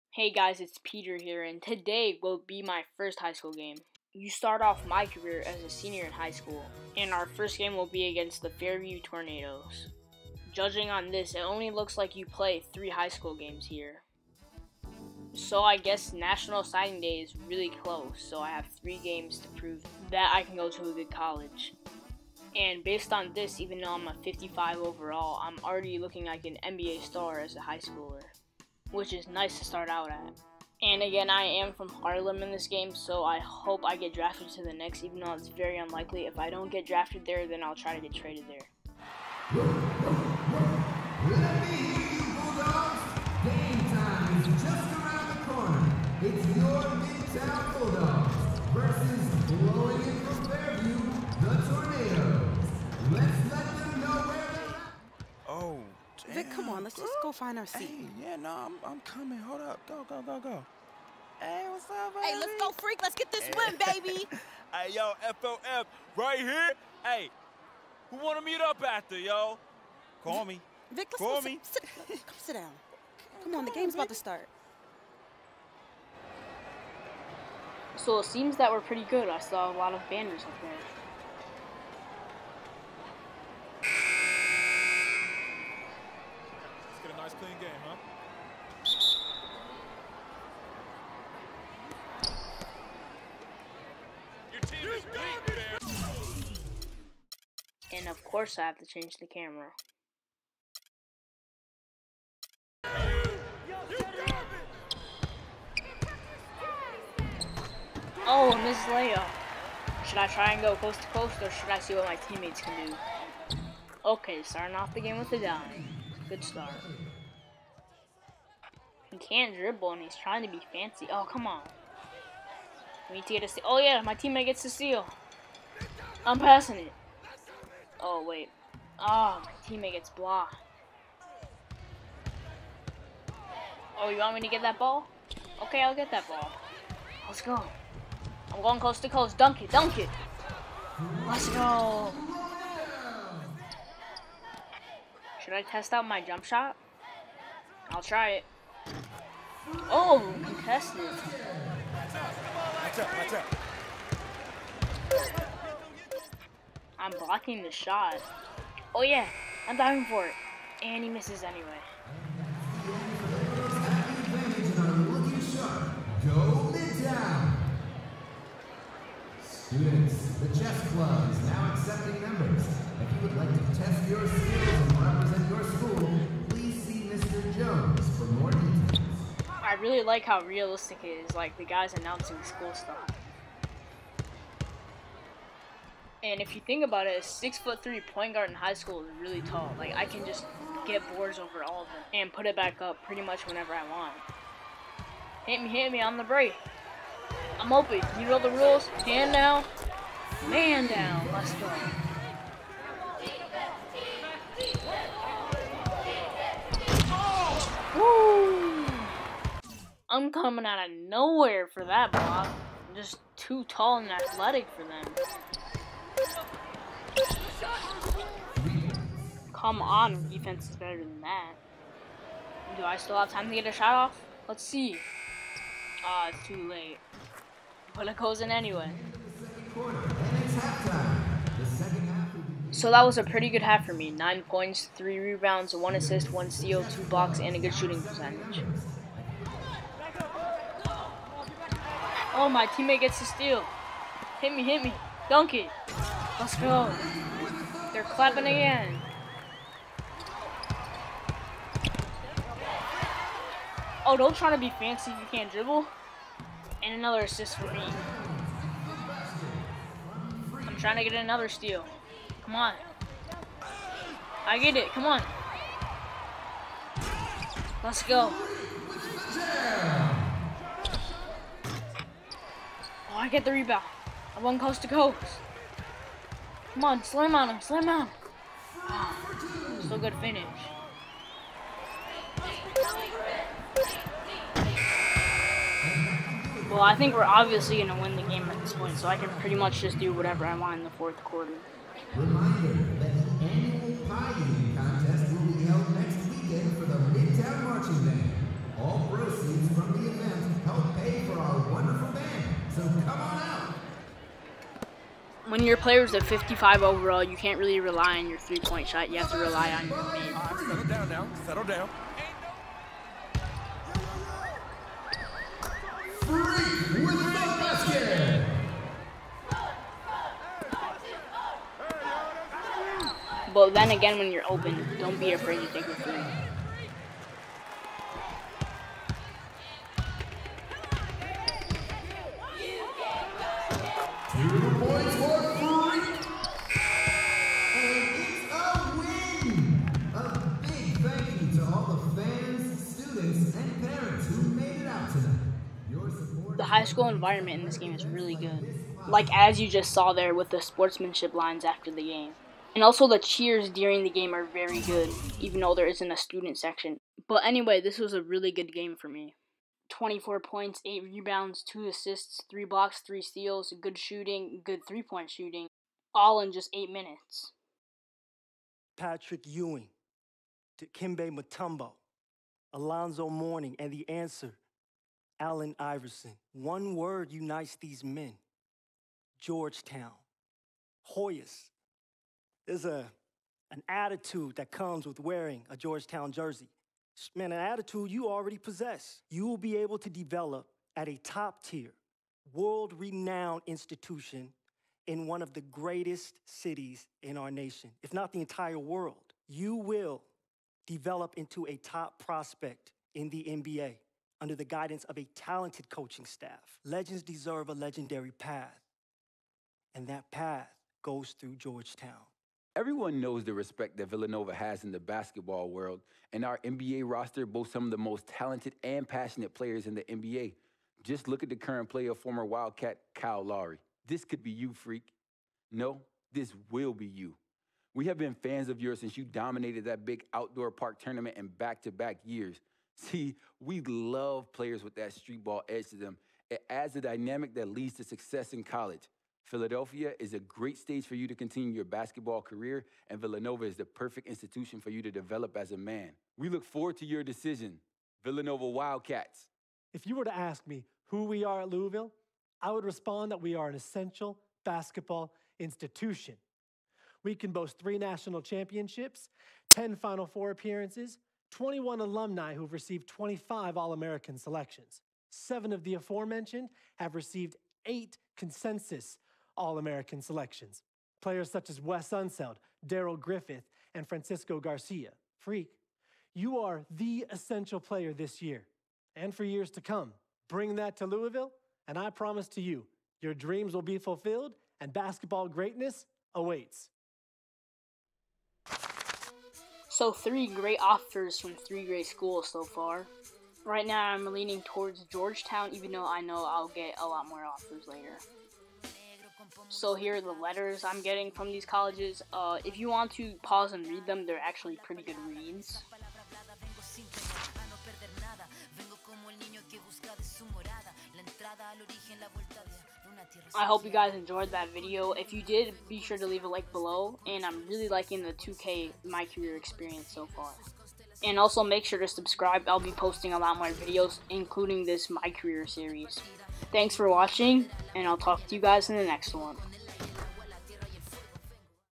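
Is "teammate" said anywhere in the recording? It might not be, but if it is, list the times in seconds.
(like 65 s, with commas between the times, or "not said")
112 s, 124 s, 129 s, 242 s.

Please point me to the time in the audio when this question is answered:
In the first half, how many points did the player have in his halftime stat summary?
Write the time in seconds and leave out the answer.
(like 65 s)
234 s.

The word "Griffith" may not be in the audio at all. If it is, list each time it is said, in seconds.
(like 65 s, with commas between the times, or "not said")
473 s.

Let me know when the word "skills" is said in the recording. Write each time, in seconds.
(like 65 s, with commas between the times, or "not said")
174 s.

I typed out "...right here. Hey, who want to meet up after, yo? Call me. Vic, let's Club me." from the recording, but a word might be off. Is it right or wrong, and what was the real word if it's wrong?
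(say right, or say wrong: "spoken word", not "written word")
wrong: "Call", not "Club".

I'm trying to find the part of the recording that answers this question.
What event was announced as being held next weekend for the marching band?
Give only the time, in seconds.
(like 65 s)
293 s.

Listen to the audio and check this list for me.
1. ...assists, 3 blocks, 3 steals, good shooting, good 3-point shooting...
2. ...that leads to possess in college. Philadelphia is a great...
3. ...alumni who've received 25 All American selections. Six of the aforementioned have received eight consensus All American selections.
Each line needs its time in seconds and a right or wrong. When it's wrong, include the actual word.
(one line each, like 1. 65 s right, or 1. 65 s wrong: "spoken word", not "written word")
1. 361 s right
2. 437 s wrong: "success", not "possess"
3. 462 s wrong: "Seven", not "Six".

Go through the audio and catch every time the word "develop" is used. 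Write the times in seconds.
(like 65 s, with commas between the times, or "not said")
390 s, 400 s, 445 s.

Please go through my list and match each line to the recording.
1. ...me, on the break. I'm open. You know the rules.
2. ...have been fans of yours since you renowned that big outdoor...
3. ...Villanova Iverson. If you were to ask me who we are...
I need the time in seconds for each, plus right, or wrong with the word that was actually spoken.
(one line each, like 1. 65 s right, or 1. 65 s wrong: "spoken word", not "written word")
1. 195 s right
2. 428 s wrong: "dominated", not "renowned"
3. 448 s wrong: "Wildcats", not "Iverson".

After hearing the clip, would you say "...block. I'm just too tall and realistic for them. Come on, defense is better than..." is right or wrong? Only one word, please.
wrong.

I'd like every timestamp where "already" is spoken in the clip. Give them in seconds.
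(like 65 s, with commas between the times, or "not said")
25 s, 388 s.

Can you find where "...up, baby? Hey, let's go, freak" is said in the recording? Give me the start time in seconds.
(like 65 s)
61 s.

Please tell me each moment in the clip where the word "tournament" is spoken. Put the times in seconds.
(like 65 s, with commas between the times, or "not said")
430 s.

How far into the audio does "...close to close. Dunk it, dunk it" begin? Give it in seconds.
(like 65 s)
138 s.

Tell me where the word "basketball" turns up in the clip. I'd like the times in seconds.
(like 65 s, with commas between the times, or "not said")
414 s, 441 s, 454 s, 484 s.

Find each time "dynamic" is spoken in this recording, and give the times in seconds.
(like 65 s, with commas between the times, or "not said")
437 s.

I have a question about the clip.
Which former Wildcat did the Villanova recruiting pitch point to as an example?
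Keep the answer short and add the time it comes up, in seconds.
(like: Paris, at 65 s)
Kyle Lowry, at 423 s.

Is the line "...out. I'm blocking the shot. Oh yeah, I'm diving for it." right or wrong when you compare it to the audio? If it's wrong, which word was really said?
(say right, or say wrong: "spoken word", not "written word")
right.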